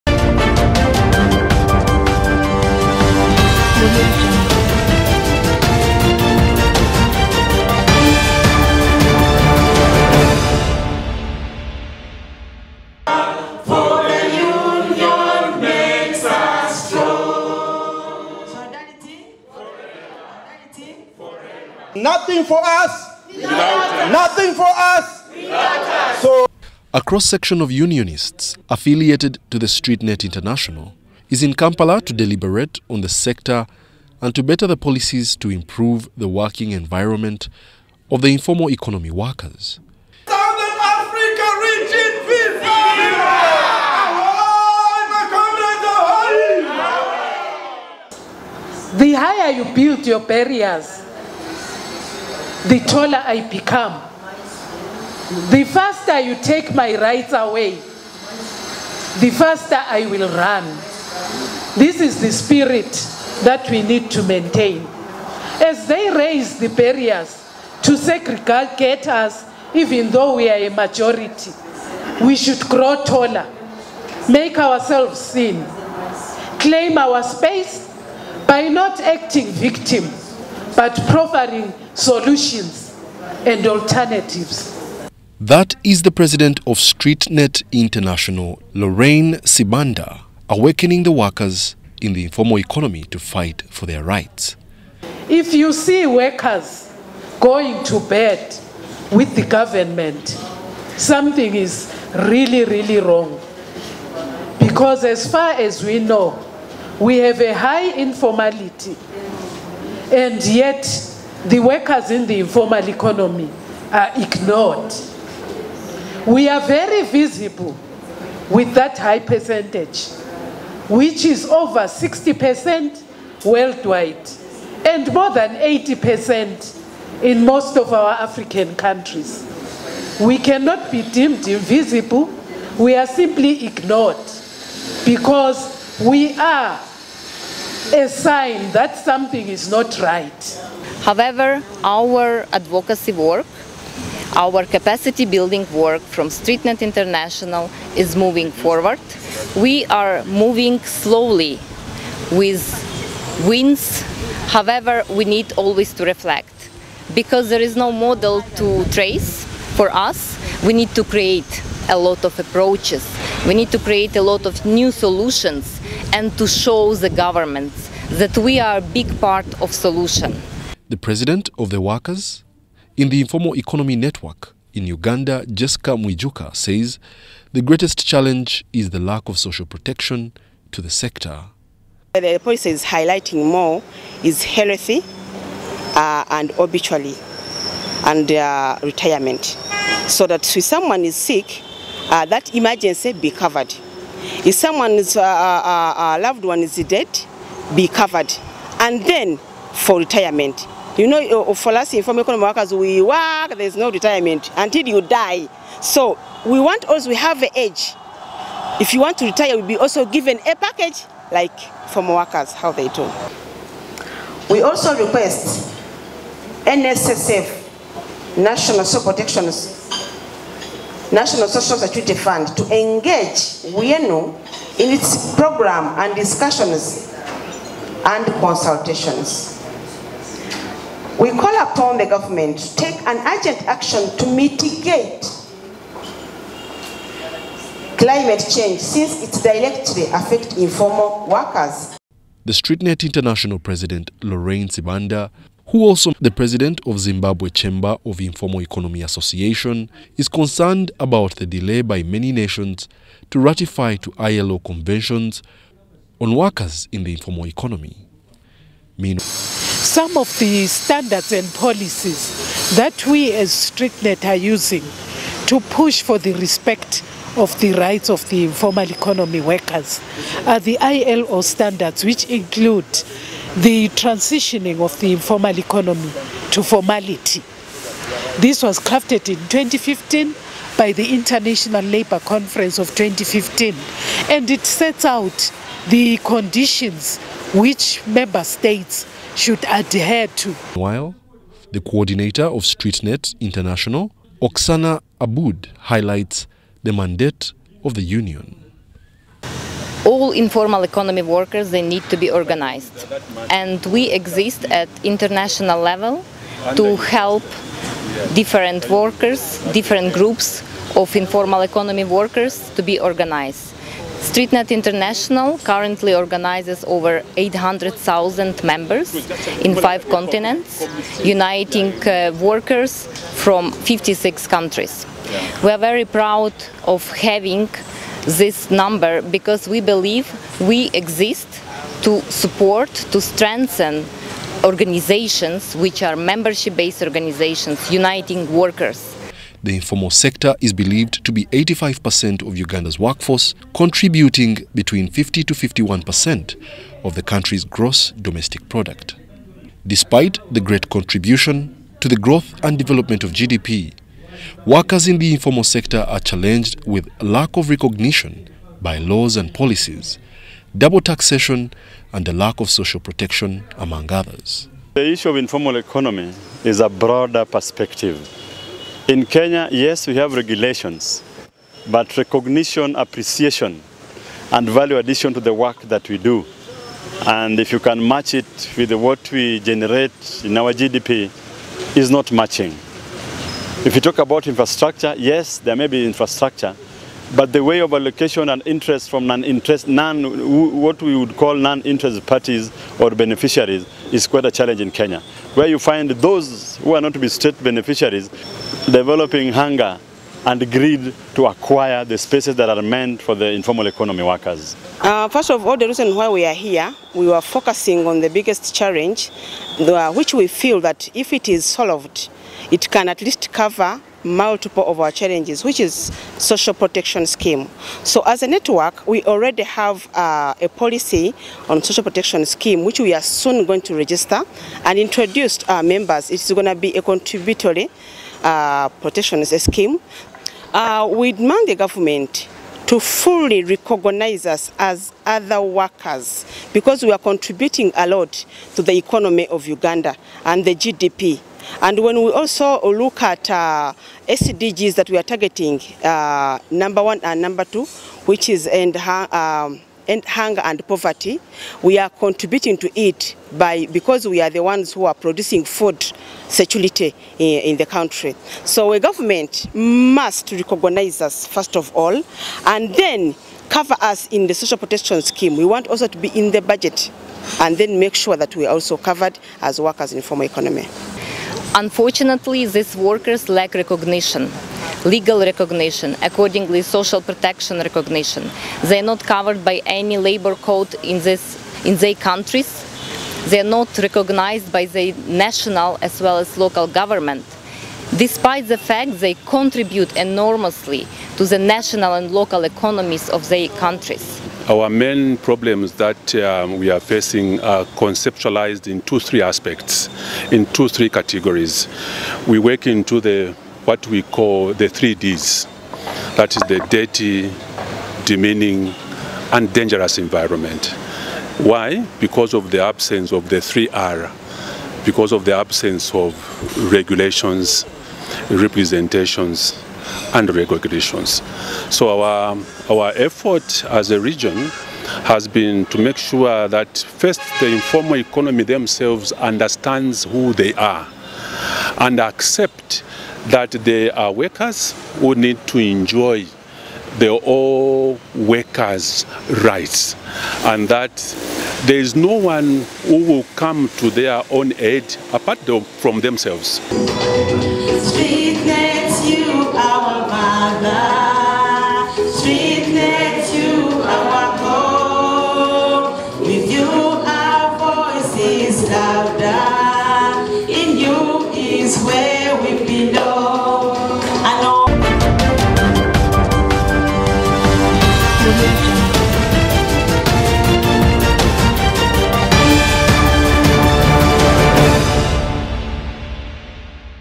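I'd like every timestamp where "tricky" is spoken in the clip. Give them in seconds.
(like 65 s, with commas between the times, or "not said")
not said.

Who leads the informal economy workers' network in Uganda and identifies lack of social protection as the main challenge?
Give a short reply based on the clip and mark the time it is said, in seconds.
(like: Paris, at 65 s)
Jesca Mwijuka, at 175 s.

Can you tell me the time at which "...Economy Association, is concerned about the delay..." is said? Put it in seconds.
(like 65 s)
248 s.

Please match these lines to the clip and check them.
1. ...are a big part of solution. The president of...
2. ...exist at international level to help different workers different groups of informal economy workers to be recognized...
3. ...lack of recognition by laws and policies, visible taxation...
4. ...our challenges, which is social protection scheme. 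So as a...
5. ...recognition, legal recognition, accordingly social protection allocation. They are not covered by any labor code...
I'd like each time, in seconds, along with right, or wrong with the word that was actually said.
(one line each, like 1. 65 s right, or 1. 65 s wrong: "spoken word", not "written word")
1. 168 s right
2. 304 s wrong: "organized", not "recognized"
3. 357 s wrong: "double", not "visible"
4. 414 s right
5. 473 s wrong: "recognition", not "allocation".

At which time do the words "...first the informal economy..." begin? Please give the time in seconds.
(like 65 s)
526 s.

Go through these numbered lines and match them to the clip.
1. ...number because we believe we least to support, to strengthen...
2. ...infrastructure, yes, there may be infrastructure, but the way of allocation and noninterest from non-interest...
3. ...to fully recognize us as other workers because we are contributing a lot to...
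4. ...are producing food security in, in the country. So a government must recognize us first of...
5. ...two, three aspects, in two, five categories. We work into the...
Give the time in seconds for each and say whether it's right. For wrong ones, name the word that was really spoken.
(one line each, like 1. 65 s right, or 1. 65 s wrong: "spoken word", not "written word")
1. 328 s wrong: "exist", not "least"
2. 384 s wrong: "interest", not "noninterest"
3. 432 s right
4. 455 s right
5. 499 s wrong: "three", not "five".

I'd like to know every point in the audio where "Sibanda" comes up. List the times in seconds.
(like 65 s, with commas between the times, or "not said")
89 s, 244 s.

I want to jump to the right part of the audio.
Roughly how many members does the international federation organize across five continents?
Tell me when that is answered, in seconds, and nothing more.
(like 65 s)
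317 s.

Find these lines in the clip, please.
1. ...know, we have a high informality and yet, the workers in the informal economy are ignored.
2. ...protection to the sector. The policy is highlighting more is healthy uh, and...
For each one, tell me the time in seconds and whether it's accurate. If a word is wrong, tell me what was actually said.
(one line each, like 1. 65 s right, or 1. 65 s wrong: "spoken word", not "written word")
1. 105 s right
2. 179 s right.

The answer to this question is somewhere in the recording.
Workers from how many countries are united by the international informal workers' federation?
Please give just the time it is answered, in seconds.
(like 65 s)
323 s.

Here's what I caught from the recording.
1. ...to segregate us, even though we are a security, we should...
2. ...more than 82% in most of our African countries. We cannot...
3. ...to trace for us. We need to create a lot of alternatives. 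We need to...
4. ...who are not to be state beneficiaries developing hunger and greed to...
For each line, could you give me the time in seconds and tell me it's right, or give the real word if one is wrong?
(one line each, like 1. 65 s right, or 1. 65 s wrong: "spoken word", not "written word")
1. 67 s wrong: "majority", not "security"
2. 125 s wrong: "80", not "82"
3. 158 s wrong: "approaches", not "alternatives"
4. 396 s right.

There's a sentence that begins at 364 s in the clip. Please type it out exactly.
The issue of informal economy is a broader perspective.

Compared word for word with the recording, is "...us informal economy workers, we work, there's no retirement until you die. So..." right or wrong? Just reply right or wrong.
right.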